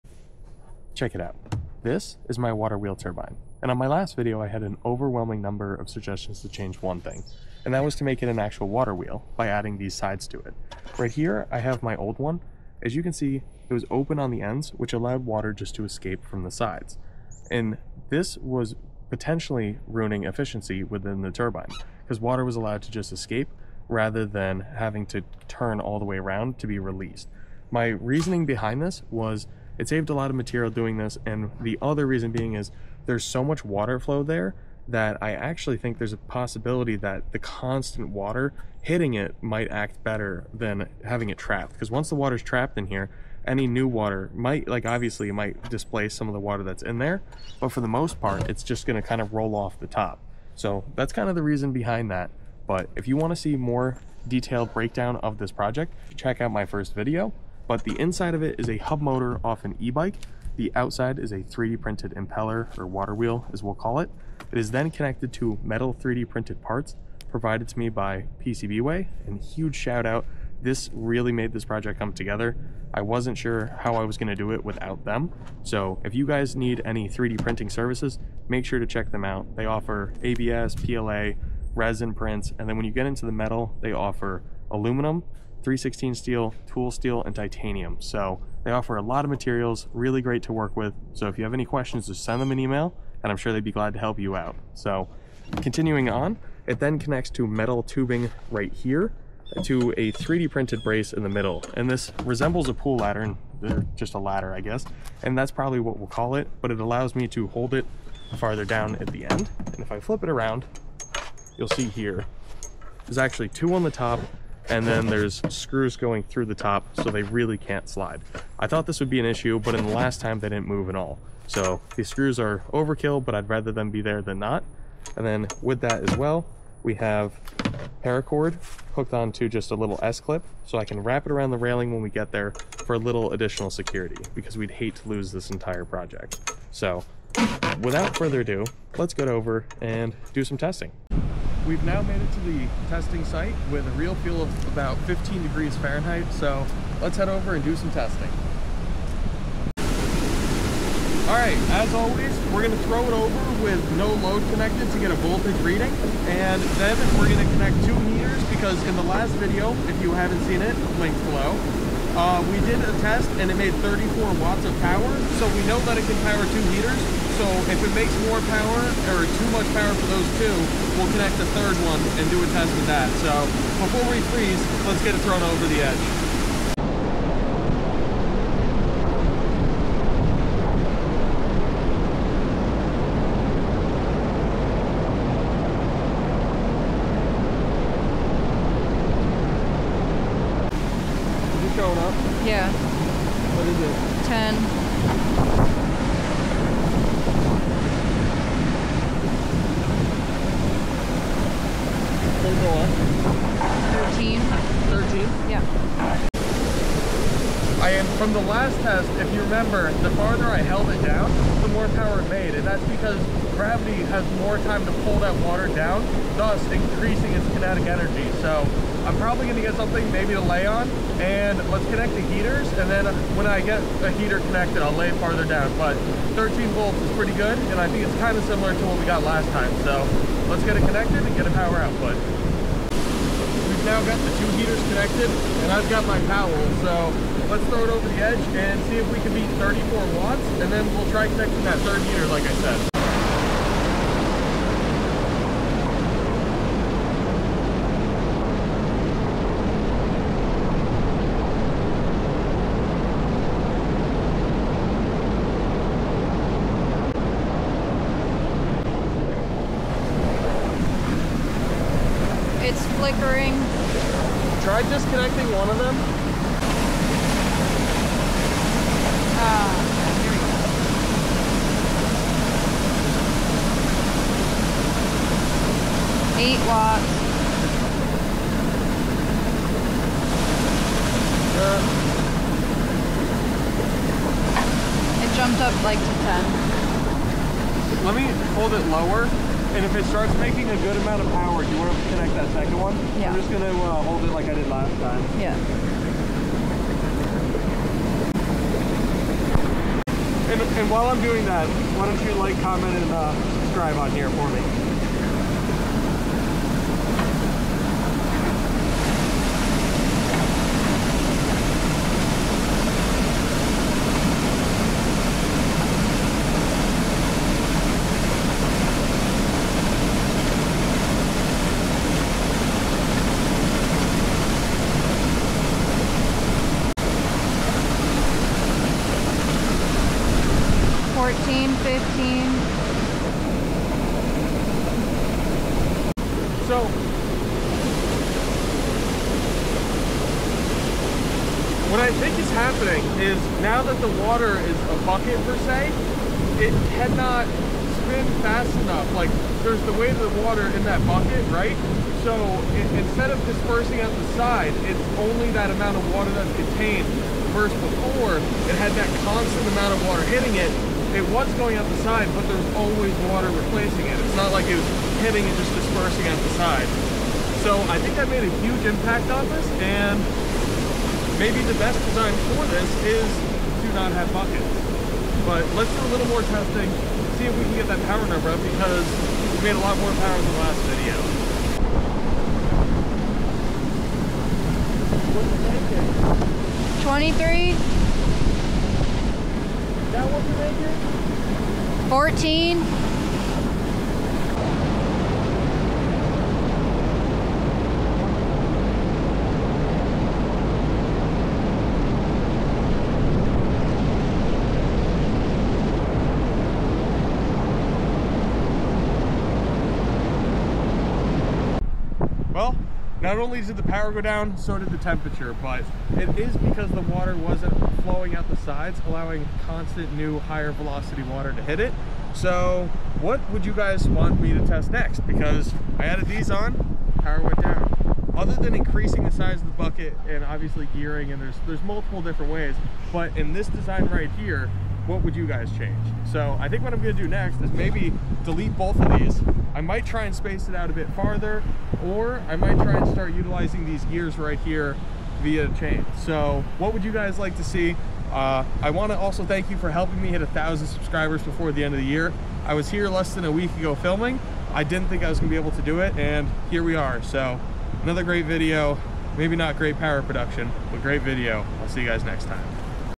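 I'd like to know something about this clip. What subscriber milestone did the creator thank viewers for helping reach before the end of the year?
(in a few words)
1,000 subscribers.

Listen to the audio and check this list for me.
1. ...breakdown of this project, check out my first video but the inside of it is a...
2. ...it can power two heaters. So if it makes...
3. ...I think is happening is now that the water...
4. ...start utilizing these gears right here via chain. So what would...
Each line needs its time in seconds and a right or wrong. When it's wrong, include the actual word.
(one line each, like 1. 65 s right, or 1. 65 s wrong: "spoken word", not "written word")
1. 54 s right
2. 165 s right
3. 341 s right
4. 443 s right.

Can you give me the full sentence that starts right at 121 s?
So these screws are overkill, but I'd rather them be there than not.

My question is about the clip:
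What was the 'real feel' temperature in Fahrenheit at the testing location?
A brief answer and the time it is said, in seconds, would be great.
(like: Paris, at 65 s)
15 degrees, at 145 s.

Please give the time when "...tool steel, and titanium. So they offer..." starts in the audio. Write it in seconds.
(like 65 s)
86 s.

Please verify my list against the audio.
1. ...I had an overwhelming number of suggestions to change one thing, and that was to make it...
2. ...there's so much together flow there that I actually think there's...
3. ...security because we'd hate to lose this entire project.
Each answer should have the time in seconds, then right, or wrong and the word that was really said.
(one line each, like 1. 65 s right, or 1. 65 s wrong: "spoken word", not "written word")
1. 4 s right
2. 33 s wrong: "water", not "together"
3. 133 s right.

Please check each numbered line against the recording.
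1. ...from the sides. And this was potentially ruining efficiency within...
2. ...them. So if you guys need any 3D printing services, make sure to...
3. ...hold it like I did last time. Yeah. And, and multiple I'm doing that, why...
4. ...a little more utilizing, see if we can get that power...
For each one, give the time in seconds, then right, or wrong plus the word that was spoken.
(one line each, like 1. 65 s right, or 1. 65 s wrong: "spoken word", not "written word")
1. 16 s right
2. 75 s right
3. 294 s wrong: "while", not "multiple"
4. 375 s wrong: "testing", not "utilizing".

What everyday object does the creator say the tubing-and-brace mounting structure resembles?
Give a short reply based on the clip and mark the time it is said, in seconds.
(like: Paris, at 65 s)
pool ladder, at 102 s.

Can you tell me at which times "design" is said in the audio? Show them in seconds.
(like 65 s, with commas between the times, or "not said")
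372 s, 433 s.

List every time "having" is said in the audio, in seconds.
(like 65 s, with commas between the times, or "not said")
24 s, 41 s.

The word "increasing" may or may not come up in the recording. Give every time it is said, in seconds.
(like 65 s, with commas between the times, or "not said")
216 s, 428 s.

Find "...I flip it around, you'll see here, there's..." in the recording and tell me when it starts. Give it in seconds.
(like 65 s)
109 s.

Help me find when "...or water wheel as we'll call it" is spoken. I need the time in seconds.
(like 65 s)
62 s.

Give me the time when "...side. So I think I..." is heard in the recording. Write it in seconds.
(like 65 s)
366 s.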